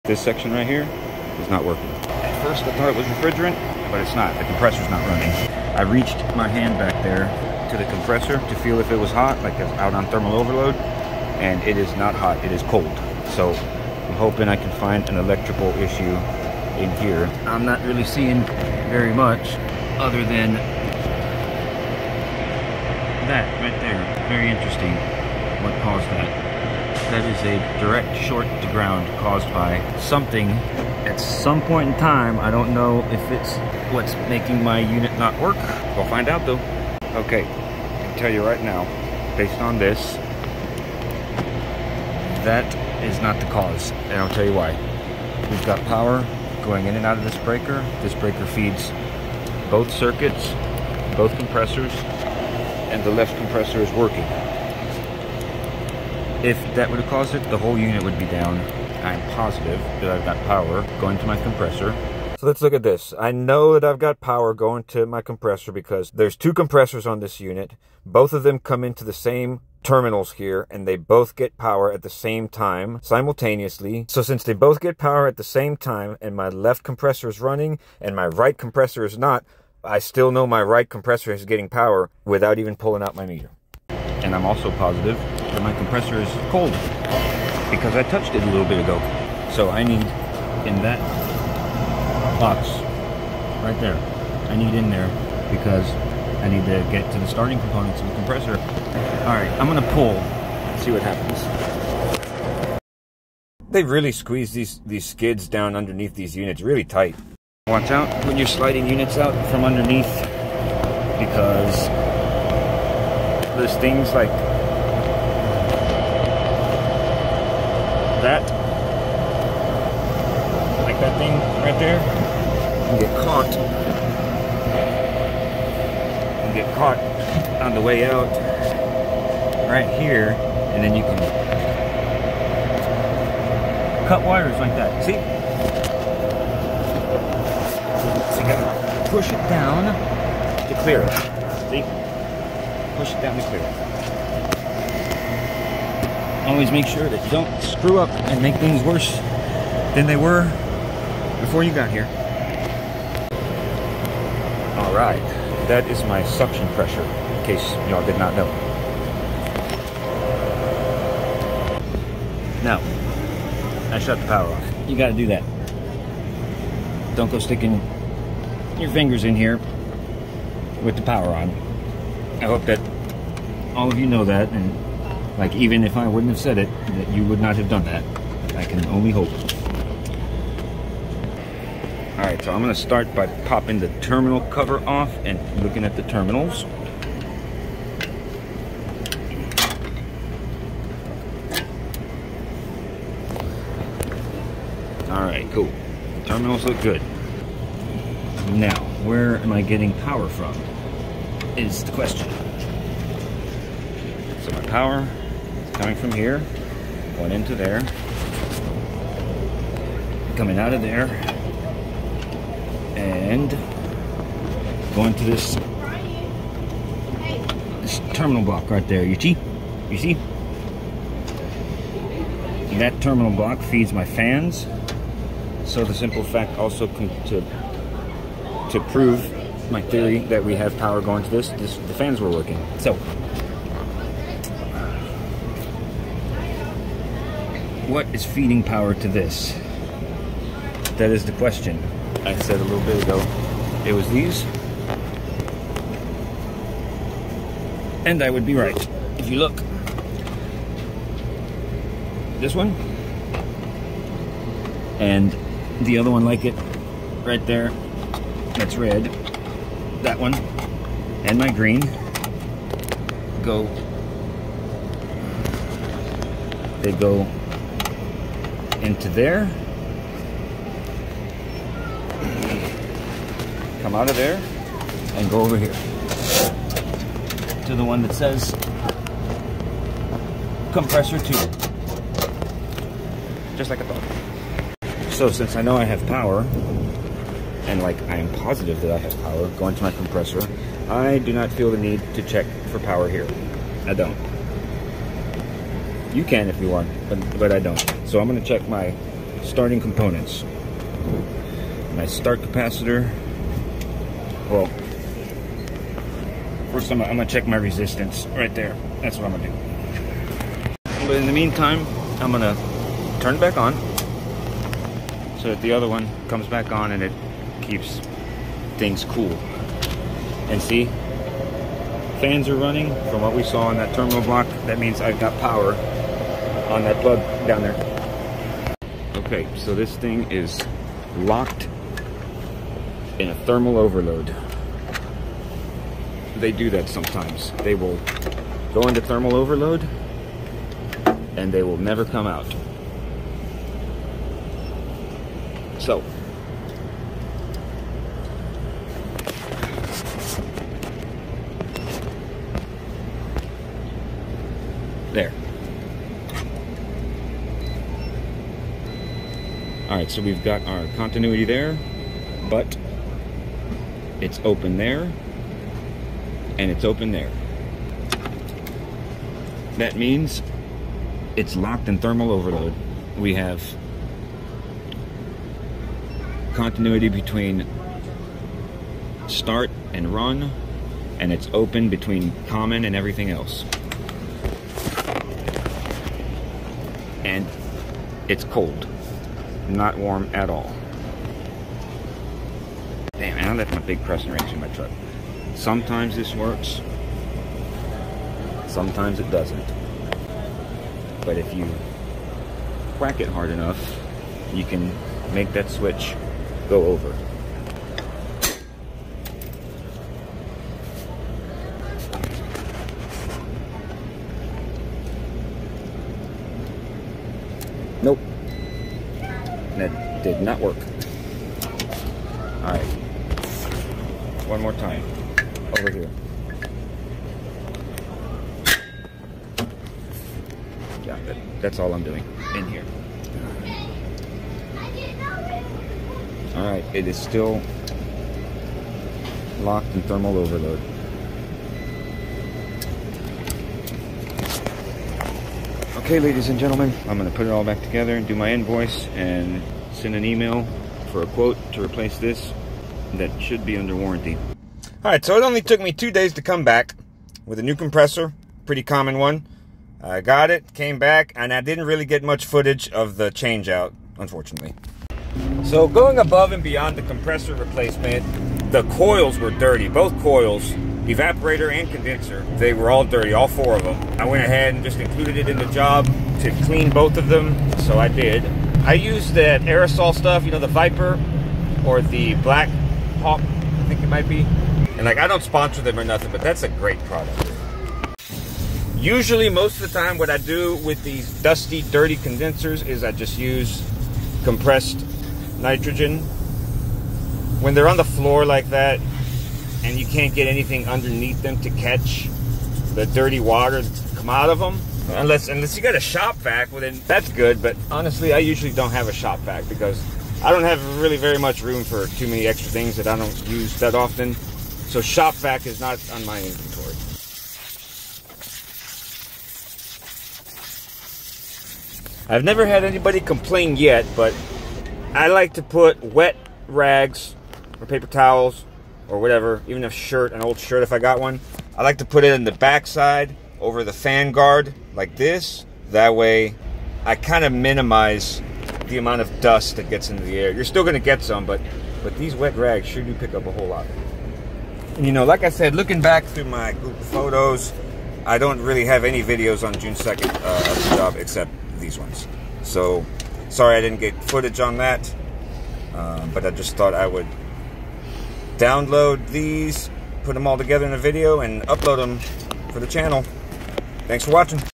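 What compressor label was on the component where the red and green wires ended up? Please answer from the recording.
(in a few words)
compressor two.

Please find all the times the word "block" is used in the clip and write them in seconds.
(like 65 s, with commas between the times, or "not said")
218 s, 223 s, 324 s.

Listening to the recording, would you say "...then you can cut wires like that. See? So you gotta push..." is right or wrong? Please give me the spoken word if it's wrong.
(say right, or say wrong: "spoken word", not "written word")
right.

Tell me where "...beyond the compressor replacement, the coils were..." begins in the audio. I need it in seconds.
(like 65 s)
466 s.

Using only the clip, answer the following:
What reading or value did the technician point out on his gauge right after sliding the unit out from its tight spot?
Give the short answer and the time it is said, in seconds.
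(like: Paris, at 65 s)
suction pressure, at 156 s.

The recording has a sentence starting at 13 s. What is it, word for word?
So I'm hoping I can find an electrical issue in here.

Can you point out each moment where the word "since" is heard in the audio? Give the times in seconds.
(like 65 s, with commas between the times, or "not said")
74 s, 285 s.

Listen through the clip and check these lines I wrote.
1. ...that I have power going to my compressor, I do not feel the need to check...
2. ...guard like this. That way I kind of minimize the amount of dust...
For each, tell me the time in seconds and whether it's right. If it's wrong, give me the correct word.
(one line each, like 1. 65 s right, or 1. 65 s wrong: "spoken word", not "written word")
1. 288 s right
2. 534 s right.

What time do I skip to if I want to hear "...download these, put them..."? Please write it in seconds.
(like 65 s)
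558 s.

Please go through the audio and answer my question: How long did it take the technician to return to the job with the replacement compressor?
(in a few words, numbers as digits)
2 days.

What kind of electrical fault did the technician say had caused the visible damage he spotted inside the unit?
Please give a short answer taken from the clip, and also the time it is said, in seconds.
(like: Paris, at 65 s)
direct short to ground, at 27 s.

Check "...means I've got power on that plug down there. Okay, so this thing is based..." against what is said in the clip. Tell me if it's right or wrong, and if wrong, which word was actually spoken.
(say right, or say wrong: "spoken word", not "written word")
wrong: "locked", not "based".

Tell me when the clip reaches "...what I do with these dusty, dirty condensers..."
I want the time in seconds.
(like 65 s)
490 s.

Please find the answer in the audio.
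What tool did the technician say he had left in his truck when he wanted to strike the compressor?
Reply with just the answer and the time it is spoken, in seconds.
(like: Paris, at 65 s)
big crescent wrench, at 393 s.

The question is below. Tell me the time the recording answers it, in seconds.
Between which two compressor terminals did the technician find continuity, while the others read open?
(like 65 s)
379 s.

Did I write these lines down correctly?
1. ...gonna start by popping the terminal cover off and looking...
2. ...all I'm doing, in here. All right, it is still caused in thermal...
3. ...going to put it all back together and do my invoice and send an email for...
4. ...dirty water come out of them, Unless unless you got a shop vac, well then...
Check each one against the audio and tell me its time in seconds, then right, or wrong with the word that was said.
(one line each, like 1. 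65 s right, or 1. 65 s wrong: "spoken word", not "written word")
1. 182 s right
2. 431 s wrong: "locked", not "caused"
3. 447 s right
4. 503 s right.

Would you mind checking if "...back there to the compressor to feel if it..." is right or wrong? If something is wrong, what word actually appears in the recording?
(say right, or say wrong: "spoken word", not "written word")
right.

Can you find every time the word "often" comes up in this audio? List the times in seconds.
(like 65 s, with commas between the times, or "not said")
513 s.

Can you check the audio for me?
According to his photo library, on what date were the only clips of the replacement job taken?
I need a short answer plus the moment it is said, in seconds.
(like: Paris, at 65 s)
June 2nd, at 549 s.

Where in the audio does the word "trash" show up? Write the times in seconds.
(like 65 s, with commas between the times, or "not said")
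not said.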